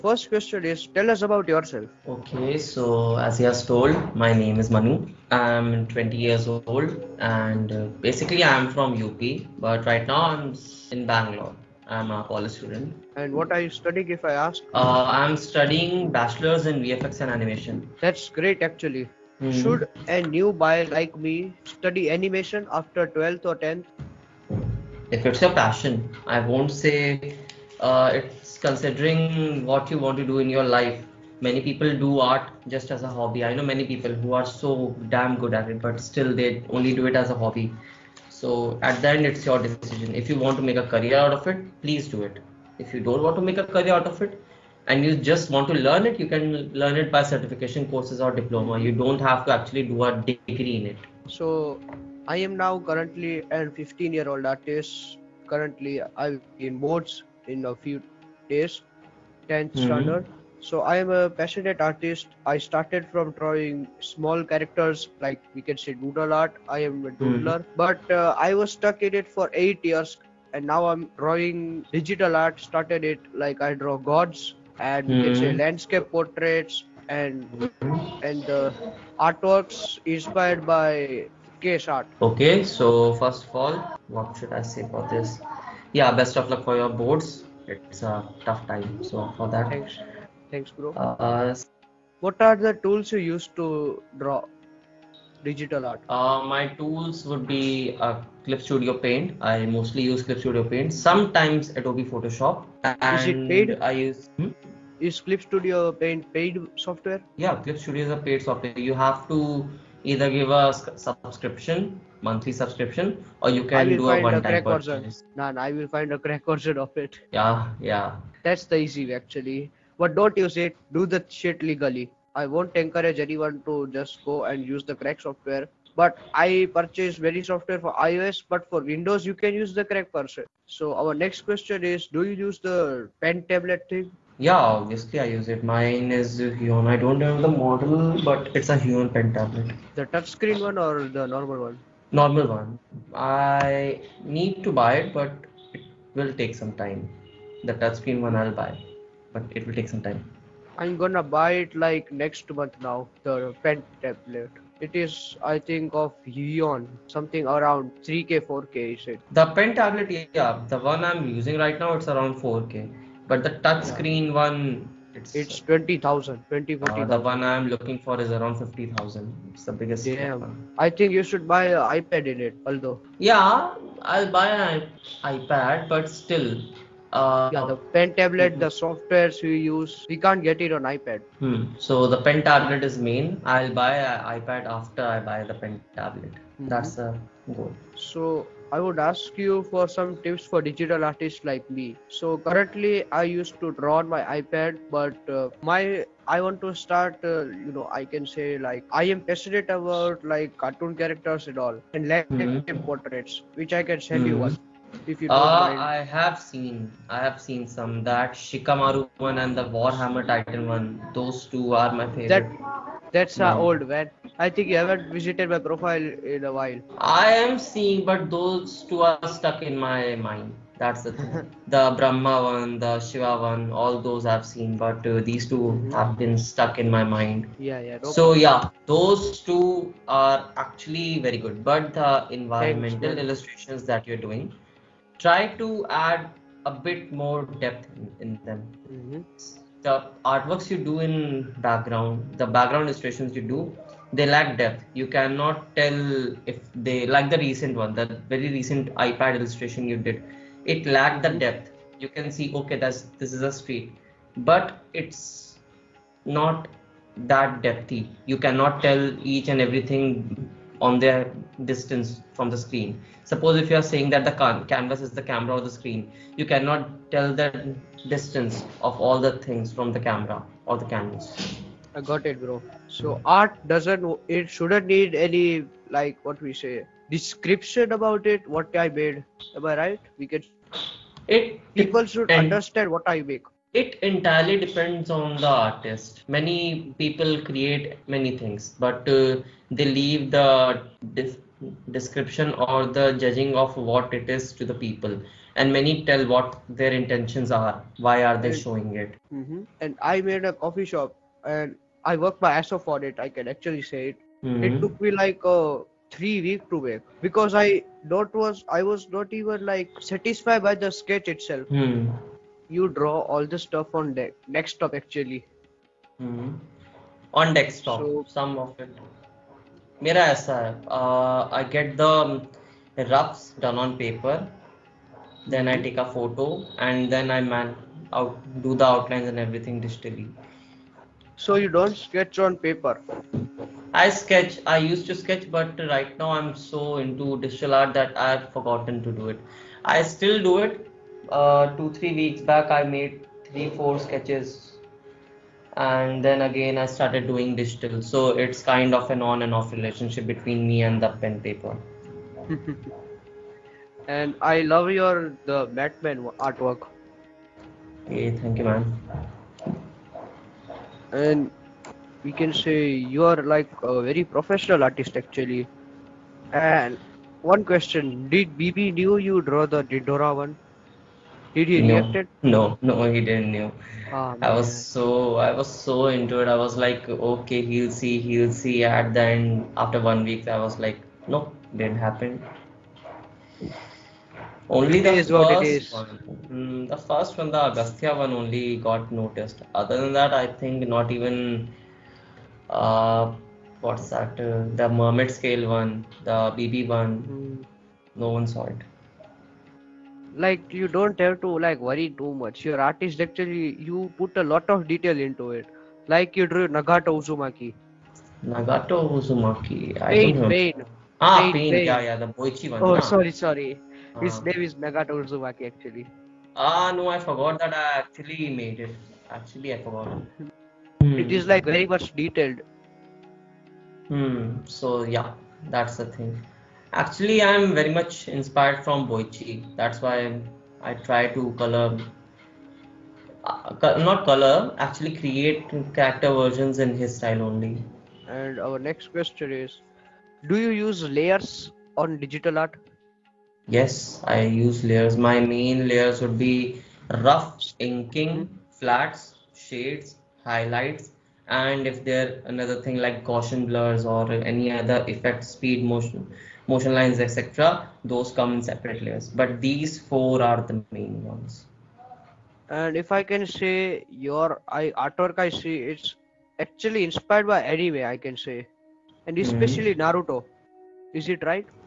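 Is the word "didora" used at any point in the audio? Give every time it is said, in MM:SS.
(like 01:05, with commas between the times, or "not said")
06:09.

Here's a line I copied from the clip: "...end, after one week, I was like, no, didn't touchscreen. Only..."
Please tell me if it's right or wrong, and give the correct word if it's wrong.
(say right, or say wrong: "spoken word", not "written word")
wrong: "happen", not "touchscreen".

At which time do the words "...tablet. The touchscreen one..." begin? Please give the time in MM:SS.
02:19.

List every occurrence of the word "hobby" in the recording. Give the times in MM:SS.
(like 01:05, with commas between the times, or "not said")
00:33, 00:37.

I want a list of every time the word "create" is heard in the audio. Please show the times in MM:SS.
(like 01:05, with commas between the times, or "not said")
04:47, 07:15.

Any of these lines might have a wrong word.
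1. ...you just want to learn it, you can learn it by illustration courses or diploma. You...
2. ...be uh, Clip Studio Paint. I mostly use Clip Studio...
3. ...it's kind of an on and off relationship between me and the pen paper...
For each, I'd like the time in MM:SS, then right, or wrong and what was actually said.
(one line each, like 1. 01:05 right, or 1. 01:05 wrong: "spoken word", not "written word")
1. 00:45 wrong: "certification", not "illustration"
2. 01:37 right
3. 05:48 right.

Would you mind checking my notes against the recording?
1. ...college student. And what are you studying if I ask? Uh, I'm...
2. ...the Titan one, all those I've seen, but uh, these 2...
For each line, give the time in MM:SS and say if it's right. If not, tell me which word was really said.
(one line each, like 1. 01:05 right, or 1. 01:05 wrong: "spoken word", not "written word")
1. 00:12 right
2. 03:42 wrong: "Shiva", not "Titan".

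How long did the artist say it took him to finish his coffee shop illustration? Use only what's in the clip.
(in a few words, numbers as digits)
Three weeks.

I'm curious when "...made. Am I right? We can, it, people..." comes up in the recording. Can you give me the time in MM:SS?
04:38.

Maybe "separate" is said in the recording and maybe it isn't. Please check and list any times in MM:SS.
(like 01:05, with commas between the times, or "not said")
07:38.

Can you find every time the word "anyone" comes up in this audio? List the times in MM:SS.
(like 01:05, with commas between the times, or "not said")
02:03.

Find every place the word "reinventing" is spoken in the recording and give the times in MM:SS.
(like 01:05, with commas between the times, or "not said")
not said.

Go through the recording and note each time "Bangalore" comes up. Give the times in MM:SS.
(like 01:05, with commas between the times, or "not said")
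00:11.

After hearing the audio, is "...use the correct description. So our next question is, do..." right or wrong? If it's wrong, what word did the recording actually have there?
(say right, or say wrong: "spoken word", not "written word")
wrong: "person", not "description".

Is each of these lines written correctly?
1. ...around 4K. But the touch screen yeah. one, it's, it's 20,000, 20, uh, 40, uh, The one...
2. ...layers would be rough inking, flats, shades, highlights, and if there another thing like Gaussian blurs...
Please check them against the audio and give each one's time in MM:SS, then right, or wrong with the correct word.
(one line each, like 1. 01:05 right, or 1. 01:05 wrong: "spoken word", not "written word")
1. 02:42 right
2. 07:25 right.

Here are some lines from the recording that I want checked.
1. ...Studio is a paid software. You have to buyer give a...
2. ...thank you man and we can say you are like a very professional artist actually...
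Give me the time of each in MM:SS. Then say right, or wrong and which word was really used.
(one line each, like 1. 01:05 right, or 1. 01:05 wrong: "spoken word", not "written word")
1. 01:47 wrong: "either", not "buyer"
2. 05:58 right.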